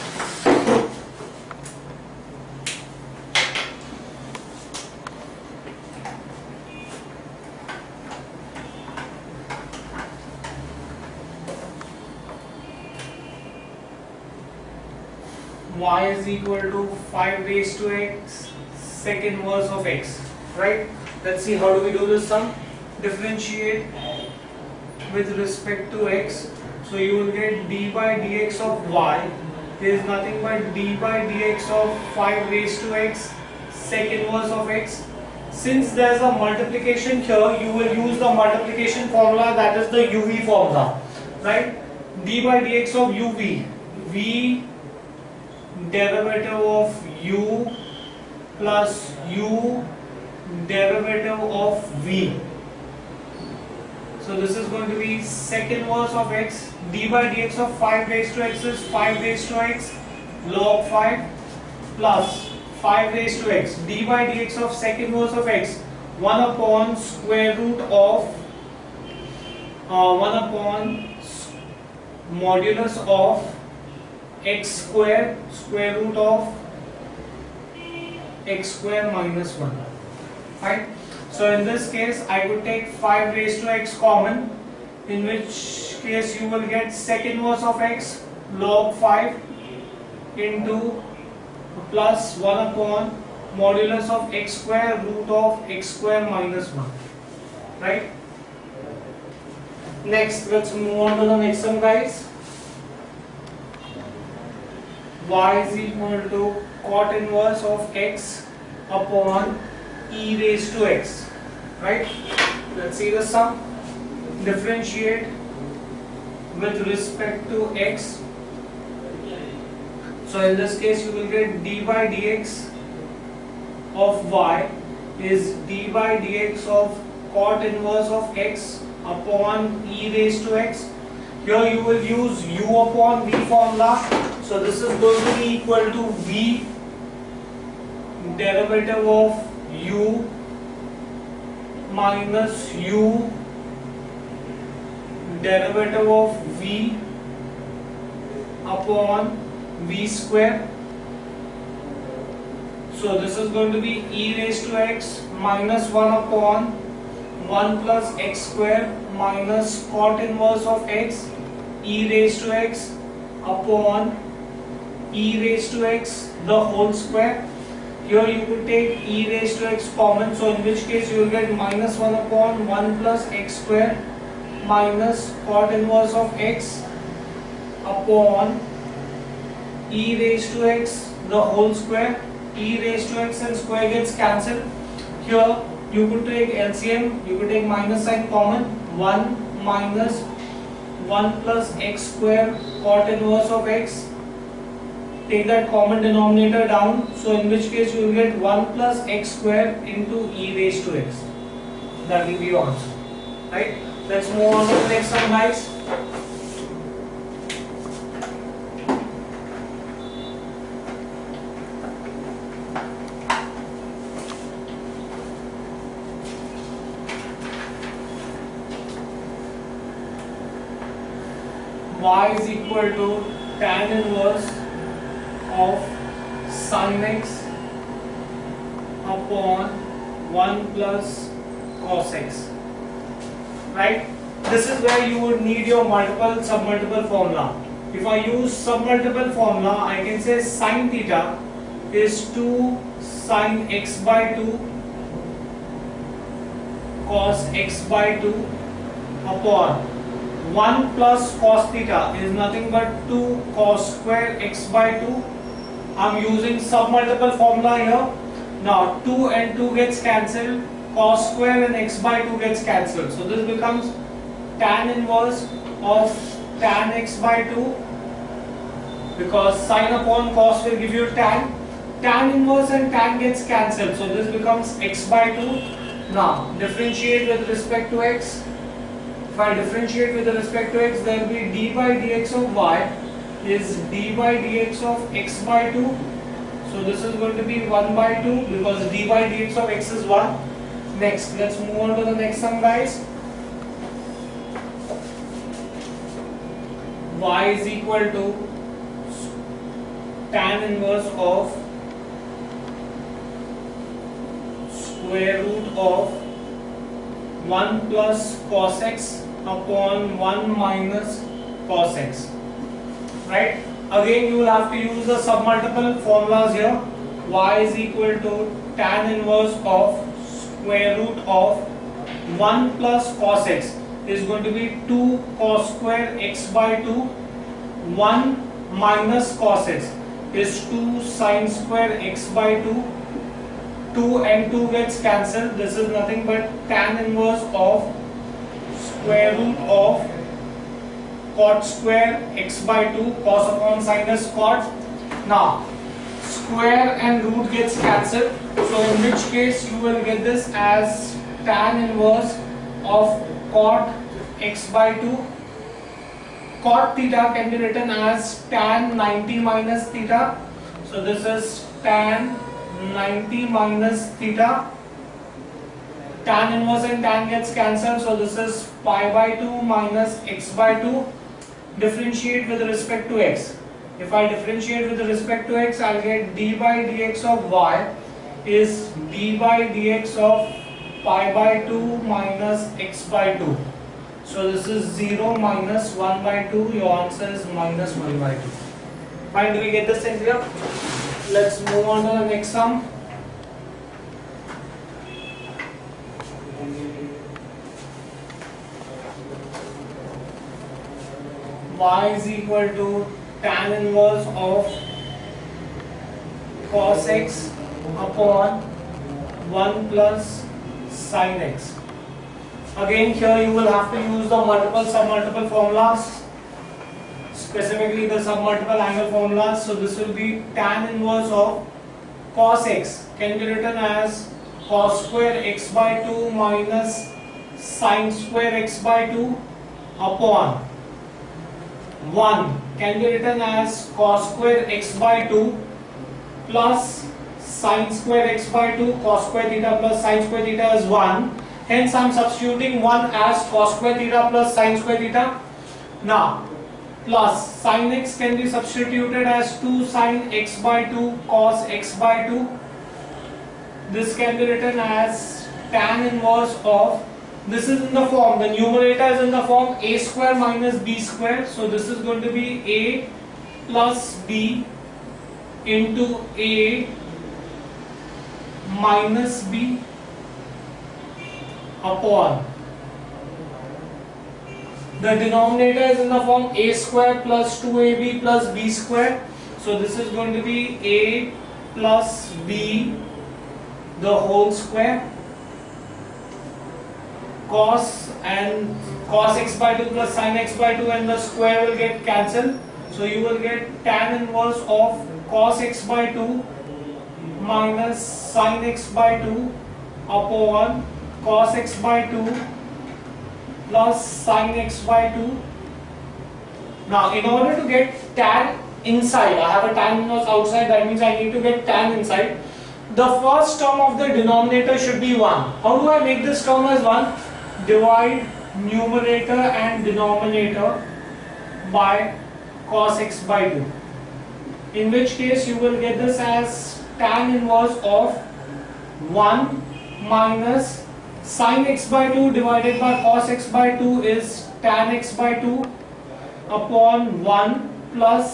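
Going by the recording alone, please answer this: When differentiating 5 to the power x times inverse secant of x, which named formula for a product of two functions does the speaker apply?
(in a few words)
uv formula.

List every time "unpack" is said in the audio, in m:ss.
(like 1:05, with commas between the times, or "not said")
not said.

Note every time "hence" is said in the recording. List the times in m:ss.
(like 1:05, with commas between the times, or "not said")
7:21.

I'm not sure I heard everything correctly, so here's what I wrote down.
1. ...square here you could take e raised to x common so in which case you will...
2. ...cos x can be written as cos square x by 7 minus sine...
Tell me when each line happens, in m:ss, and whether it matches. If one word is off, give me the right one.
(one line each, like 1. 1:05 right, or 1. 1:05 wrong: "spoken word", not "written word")
1. 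2:46 right
2. 7:02 wrong: "2", not "7".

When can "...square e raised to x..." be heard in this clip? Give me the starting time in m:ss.
3:01.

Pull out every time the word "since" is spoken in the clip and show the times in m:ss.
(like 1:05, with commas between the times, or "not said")
0:35.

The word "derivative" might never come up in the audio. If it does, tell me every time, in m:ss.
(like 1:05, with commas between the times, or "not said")
0:45, 0:50, 2:18, 2:25.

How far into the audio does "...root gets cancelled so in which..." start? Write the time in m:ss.
5:47.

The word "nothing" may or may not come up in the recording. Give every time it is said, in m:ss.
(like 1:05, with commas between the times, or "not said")
0:30, 4:12, 5:35.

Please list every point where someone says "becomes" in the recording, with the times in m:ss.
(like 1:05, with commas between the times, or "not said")
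4:23, 4:34.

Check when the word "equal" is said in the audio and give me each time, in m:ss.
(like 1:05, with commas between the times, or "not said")
0:16, 1:45, 2:15, 3:42, 4:57, 5:17, 6:42.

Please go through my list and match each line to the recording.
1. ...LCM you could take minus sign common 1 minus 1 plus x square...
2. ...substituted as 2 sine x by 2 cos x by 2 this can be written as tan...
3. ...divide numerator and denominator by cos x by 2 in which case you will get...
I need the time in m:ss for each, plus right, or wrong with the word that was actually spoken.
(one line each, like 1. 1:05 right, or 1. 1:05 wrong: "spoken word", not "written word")
1. 3:06 right
2. 7:28 right
3. 8:37 right.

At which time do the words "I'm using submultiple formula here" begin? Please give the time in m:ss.
4:16.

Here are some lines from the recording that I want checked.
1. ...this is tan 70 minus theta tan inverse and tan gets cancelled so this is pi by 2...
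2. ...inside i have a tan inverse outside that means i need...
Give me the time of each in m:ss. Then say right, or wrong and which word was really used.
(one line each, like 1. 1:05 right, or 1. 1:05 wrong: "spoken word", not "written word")
1. 6:01 wrong: "90", not "70"
2. 8:28 right.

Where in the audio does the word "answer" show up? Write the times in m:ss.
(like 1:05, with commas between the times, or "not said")
3:22, 6:26.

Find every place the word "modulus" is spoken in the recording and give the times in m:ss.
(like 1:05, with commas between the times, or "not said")
1:12, 1:33.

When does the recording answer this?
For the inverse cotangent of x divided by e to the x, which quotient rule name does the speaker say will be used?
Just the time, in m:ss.
2:12.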